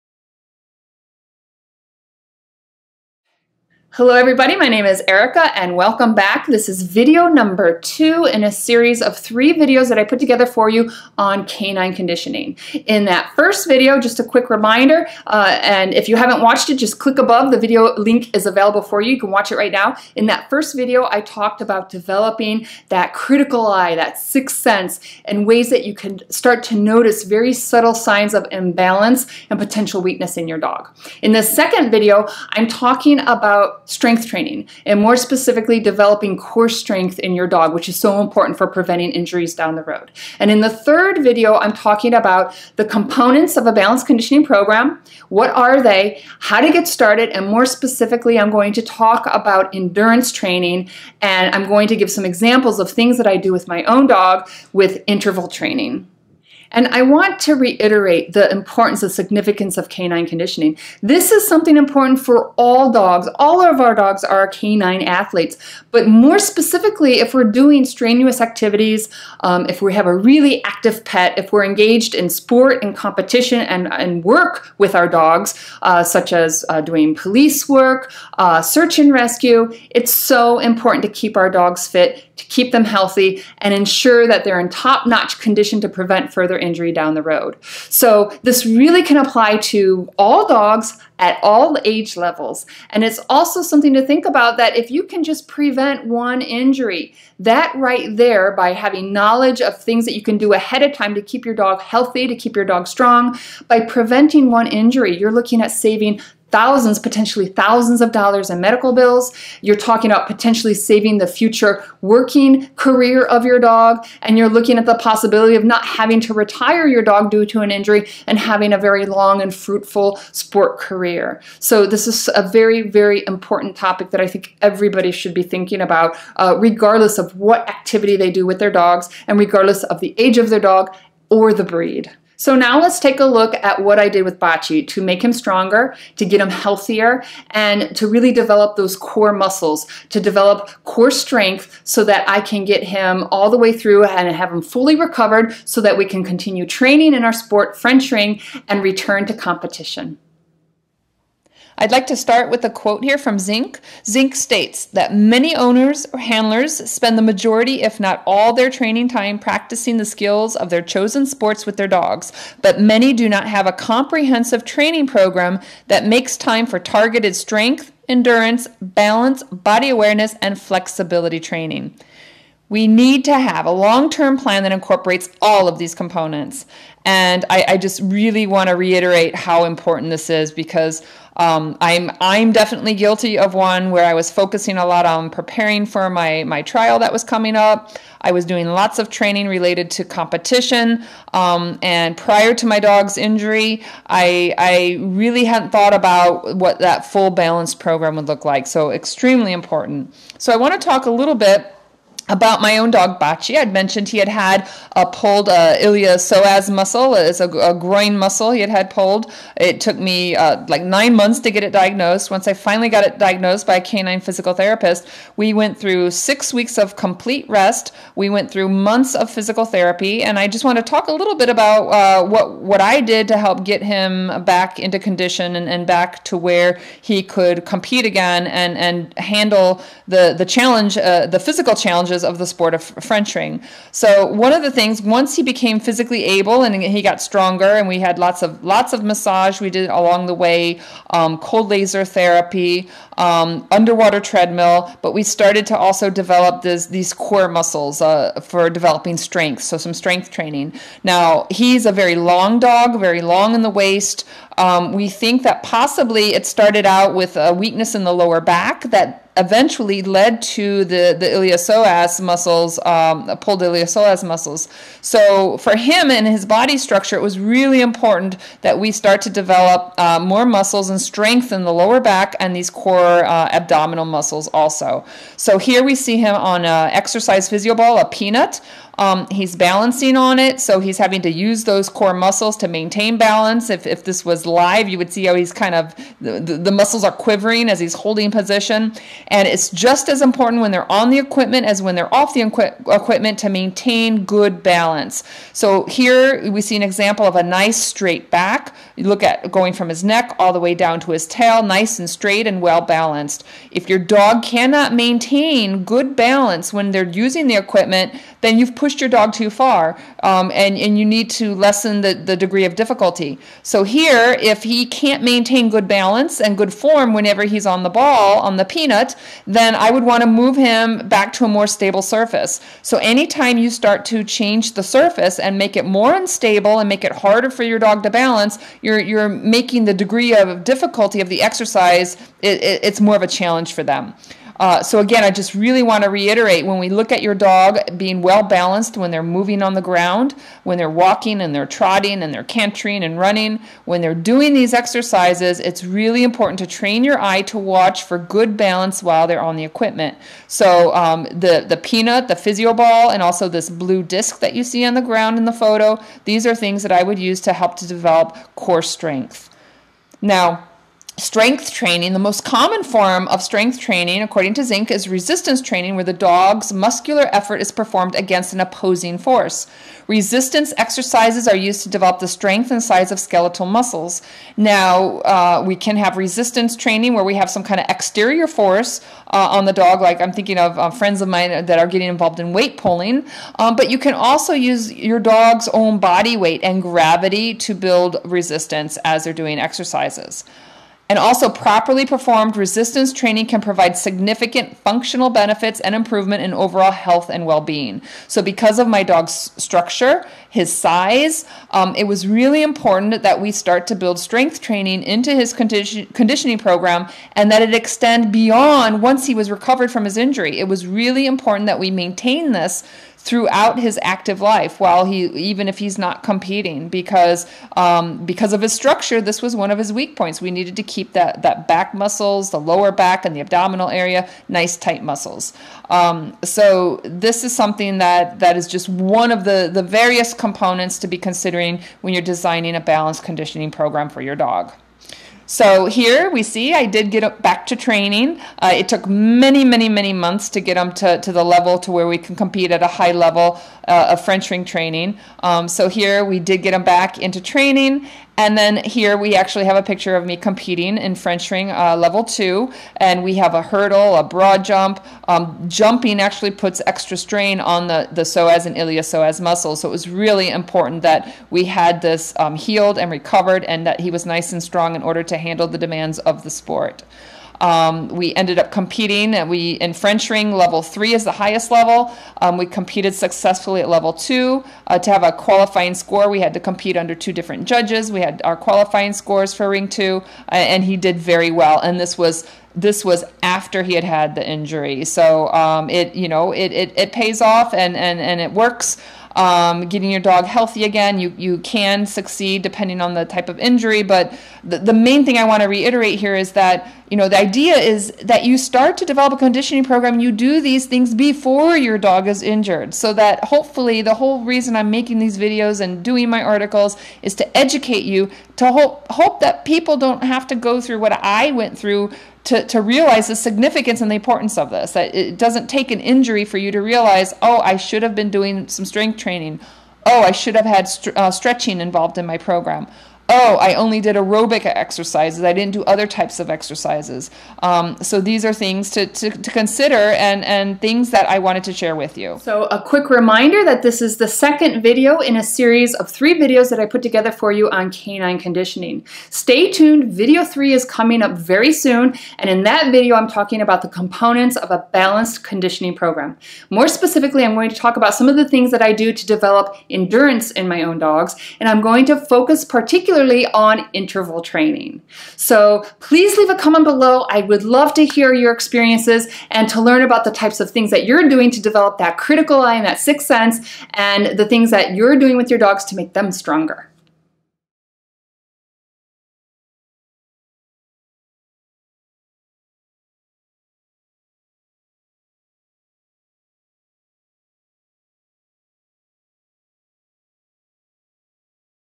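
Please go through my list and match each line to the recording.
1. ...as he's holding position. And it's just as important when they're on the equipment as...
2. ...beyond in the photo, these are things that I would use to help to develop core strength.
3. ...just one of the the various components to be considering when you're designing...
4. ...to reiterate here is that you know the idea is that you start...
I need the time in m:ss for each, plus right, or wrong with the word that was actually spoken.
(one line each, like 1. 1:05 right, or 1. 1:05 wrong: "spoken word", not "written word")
1. 4:47 right
2. 5:55 wrong: "ground", not "beyond"
3. 7:08 right
4. 8:15 right.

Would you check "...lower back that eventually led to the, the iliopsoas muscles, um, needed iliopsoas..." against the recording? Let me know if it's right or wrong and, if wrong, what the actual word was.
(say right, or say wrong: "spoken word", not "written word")
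wrong: "pulled", not "needed".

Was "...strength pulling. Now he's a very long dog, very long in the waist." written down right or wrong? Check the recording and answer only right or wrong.
wrong.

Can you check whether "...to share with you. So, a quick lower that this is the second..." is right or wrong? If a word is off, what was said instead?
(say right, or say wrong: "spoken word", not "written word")
wrong: "reminder", not "lower".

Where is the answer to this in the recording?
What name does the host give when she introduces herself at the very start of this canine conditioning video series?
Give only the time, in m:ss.
0:05.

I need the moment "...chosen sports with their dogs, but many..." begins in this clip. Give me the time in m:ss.
2:40.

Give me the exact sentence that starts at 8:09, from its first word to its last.
Um, getting your dog healthy again.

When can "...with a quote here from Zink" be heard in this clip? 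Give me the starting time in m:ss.
2:32.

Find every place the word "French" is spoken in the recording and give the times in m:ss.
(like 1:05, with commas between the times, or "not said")
2:27, 3:53, 7:24, 7:31, 7:49.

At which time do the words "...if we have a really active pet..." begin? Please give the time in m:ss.
1:09.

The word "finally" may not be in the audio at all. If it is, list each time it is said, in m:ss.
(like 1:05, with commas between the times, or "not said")
3:32.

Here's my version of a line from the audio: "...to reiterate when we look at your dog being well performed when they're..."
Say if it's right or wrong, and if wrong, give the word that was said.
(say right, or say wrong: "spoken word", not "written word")
wrong: "balanced", not "performed".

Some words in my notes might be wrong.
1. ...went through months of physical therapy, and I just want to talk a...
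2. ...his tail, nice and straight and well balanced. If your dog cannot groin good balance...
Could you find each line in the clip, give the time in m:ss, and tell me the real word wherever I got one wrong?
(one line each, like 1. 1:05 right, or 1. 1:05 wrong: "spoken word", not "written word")
1. 3:38 right
2. 5:01 wrong: "maintain", not "groin".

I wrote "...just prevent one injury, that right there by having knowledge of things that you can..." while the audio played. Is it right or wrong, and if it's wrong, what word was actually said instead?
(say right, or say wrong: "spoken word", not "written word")
right.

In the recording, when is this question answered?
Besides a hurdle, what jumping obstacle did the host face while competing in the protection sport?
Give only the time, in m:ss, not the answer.
7:34.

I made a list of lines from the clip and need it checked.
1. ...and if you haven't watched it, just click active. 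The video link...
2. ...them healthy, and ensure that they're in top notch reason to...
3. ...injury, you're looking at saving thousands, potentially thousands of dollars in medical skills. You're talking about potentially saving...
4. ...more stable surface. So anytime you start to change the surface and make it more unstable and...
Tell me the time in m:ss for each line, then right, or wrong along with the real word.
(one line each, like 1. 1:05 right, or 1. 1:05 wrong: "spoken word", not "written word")
1. 0:15 wrong: "above", not "active"
2. 1:22 wrong: "condition", not "reason"
3. 1:44 wrong: "bills", not "skills"
4. 5:21 right.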